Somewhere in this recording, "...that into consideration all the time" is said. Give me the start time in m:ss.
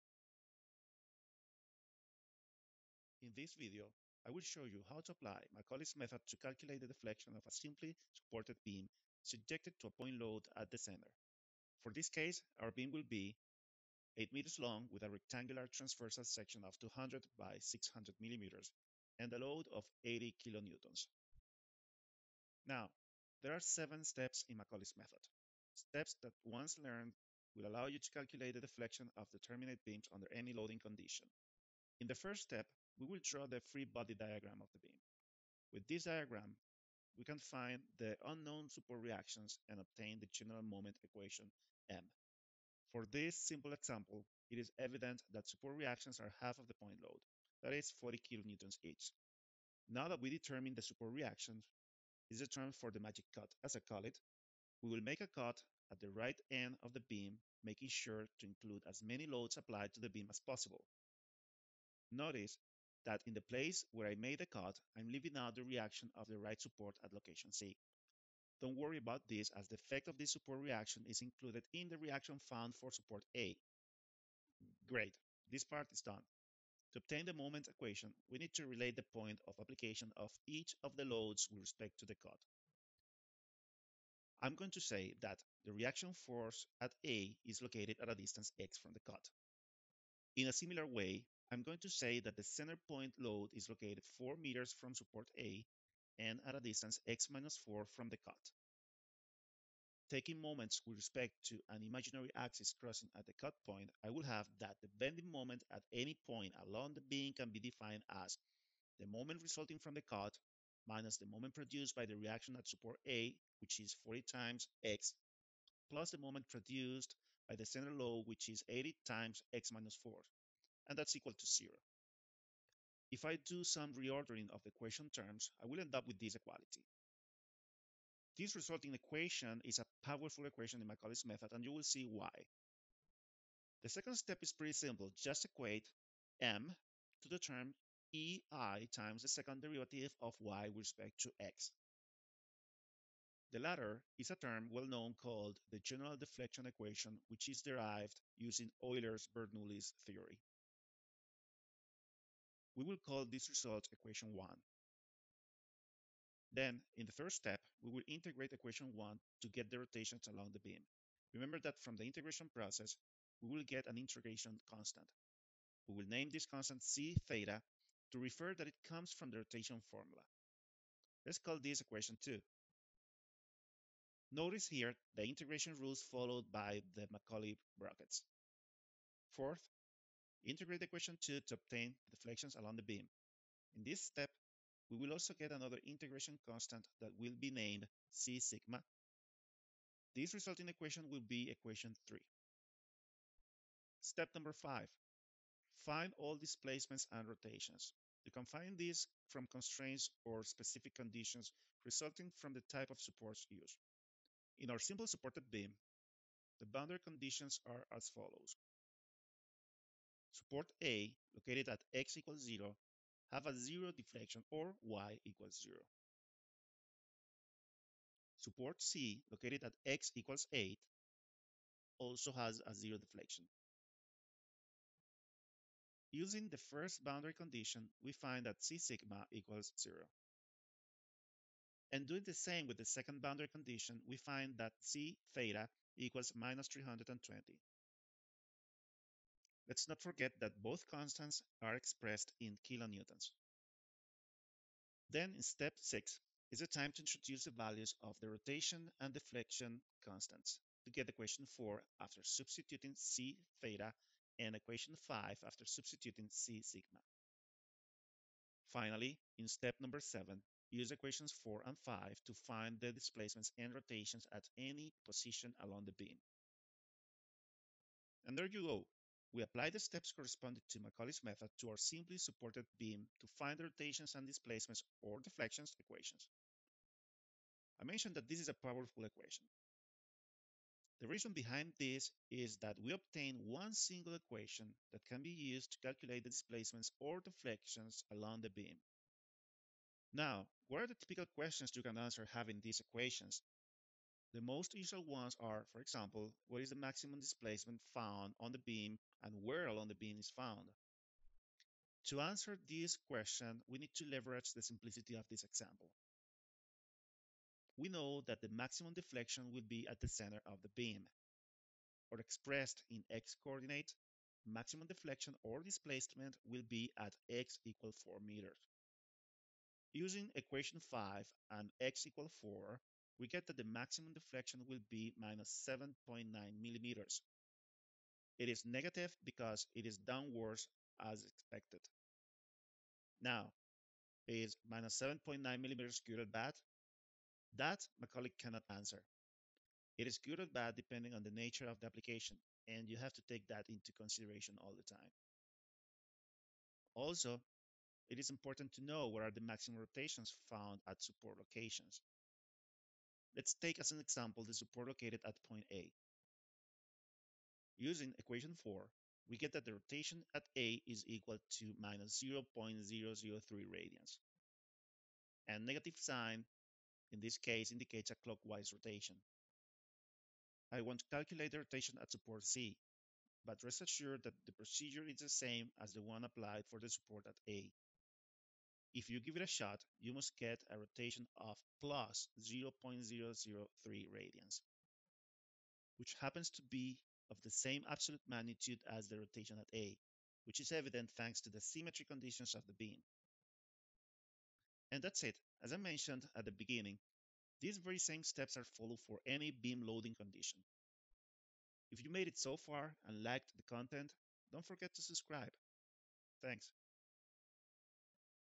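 5:43.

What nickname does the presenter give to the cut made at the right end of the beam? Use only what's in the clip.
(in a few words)
the magic cut.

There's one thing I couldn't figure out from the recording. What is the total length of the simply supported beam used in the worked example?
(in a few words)
8 meters.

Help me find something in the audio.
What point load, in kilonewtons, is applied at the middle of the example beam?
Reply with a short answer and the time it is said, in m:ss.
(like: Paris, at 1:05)
80 kilonewtons, at 0:20.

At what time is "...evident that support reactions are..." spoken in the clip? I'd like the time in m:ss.
0:44.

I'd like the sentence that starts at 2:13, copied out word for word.
The second step is pretty simple.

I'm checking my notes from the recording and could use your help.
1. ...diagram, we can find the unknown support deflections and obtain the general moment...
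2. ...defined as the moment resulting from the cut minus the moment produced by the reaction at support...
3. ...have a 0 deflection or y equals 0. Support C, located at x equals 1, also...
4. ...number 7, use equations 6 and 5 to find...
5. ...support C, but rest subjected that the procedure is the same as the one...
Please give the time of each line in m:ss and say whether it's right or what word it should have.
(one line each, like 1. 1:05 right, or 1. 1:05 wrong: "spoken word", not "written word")
1. 0:36 wrong: "reactions", not "deflections"
2. 1:47 right
3. 3:33 wrong: "8", not "1"
4. 4:19 wrong: "4", not "6"
5. 6:12 wrong: "assured", not "subjected".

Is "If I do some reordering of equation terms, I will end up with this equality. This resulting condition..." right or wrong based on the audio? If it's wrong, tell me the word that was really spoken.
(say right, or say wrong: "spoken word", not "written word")
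wrong: "equation", not "condition".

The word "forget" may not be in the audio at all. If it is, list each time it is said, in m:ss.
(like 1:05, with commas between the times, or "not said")
4:00, 6:44.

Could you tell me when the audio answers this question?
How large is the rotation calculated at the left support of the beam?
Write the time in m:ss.
6:01.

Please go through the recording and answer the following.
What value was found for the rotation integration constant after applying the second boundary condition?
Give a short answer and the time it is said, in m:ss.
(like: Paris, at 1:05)
-320, at 3:56.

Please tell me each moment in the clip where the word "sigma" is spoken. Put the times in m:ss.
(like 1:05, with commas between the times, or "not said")
3:08, 3:48, 4:16.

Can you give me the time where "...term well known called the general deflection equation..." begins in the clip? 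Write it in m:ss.
2:24.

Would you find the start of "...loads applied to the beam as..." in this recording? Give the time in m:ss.
0:59.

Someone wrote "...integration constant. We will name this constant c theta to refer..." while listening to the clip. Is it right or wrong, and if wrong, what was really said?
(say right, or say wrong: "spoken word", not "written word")
right.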